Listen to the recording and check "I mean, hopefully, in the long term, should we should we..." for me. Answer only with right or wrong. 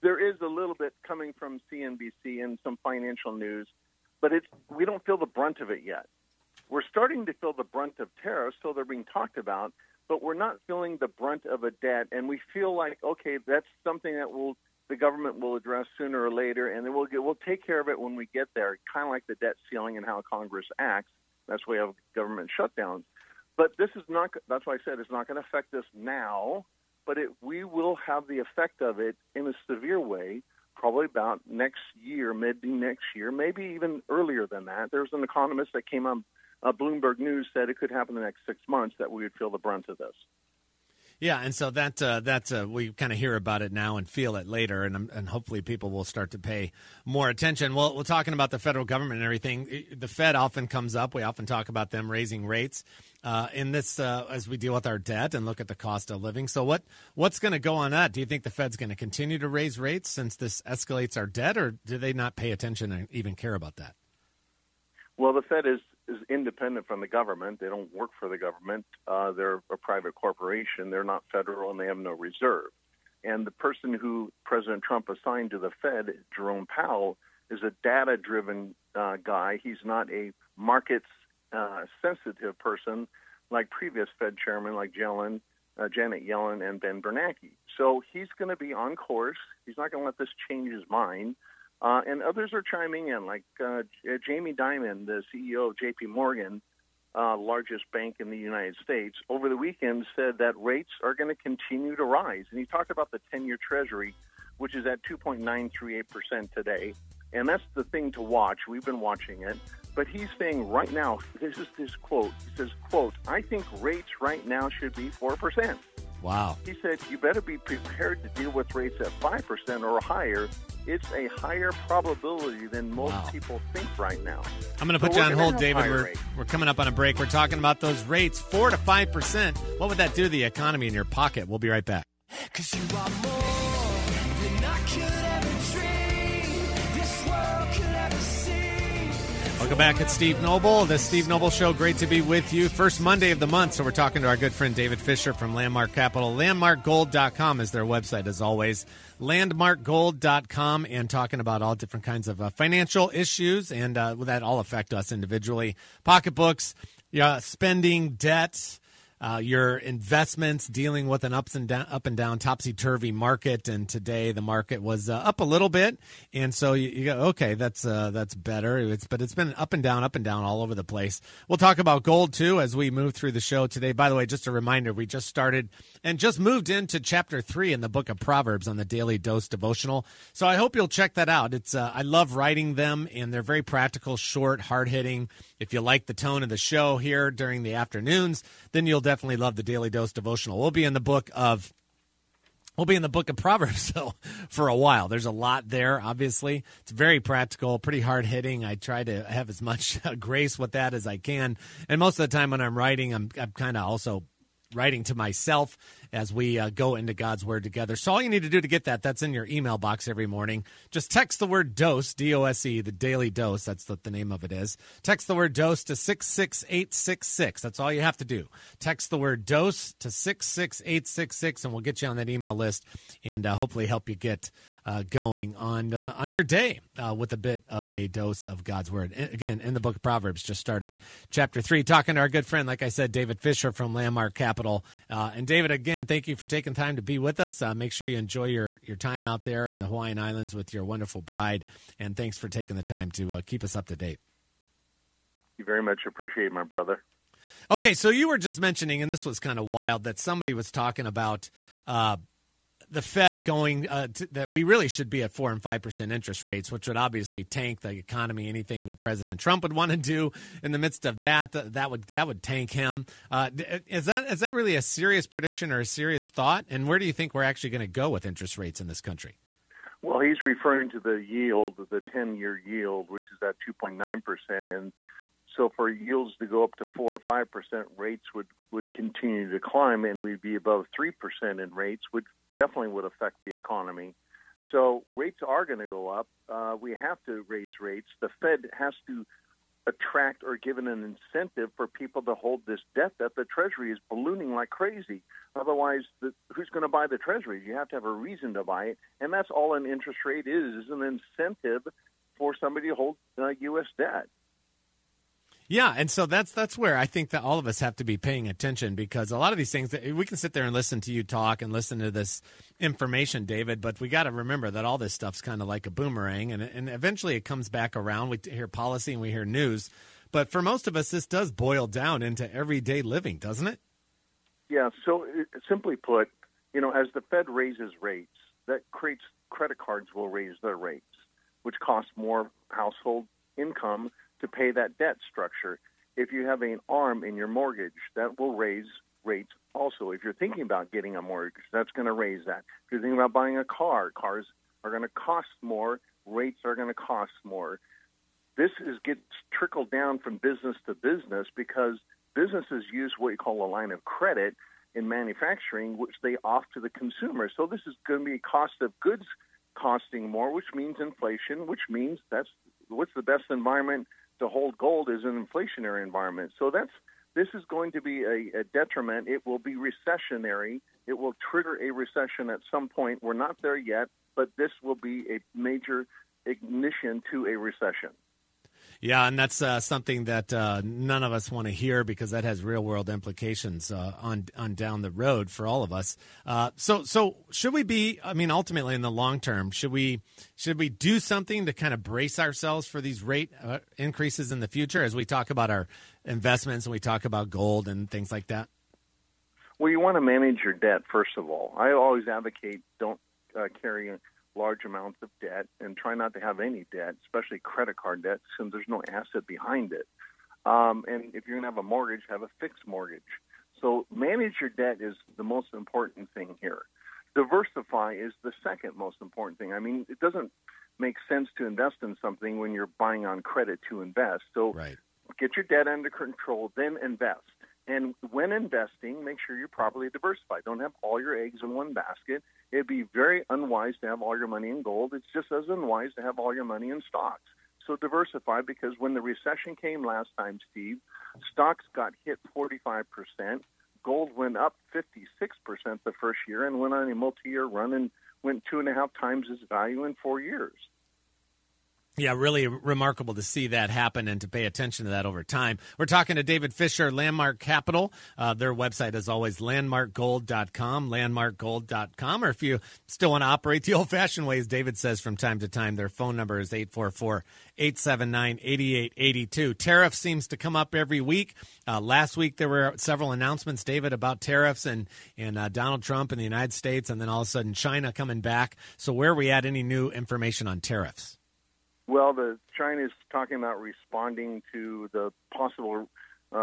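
wrong.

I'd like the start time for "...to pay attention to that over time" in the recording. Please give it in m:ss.
7:34.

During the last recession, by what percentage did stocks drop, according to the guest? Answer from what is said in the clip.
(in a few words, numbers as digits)
45%.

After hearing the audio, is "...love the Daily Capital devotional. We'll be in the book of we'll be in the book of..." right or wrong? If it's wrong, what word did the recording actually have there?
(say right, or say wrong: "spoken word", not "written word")
wrong: "Dose", not "Capital".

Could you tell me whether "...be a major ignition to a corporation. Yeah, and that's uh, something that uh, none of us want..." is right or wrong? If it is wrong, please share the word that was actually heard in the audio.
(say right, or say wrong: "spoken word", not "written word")
wrong: "recession", not "corporation".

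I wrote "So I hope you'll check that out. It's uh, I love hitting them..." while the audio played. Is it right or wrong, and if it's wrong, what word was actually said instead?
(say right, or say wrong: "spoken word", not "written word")
wrong: "writing", not "hitting".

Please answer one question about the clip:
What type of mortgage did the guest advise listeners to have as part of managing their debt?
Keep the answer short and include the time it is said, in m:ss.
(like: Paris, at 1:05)
fixed mortgage, at 6:52.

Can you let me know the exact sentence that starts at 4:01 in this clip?
And thanks for taking the time to uh, keep us up to date.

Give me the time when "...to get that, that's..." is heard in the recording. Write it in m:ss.
3:28.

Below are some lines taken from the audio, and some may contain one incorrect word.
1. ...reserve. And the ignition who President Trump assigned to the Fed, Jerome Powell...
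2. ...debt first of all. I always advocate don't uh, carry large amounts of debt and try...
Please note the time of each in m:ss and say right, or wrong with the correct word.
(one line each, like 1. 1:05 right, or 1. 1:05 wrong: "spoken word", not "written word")
1. 1:12 wrong: "person", not "ignition"
2. 6:40 right.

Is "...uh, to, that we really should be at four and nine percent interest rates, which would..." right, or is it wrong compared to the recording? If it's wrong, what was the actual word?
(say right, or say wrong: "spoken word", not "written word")
wrong: "five", not "nine".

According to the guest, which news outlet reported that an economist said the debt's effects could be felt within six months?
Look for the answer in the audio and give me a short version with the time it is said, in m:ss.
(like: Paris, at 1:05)
Bloomberg News, at 0:36.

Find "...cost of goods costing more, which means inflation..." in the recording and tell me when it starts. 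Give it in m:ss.
5:58.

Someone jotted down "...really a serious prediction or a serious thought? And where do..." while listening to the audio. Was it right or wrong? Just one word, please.
right.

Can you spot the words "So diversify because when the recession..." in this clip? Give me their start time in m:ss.
7:17.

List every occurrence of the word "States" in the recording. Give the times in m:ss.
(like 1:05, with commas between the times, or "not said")
1:38, 7:56.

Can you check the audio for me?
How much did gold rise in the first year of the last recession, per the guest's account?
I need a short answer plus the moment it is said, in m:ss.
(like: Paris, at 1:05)
56%, at 7:24.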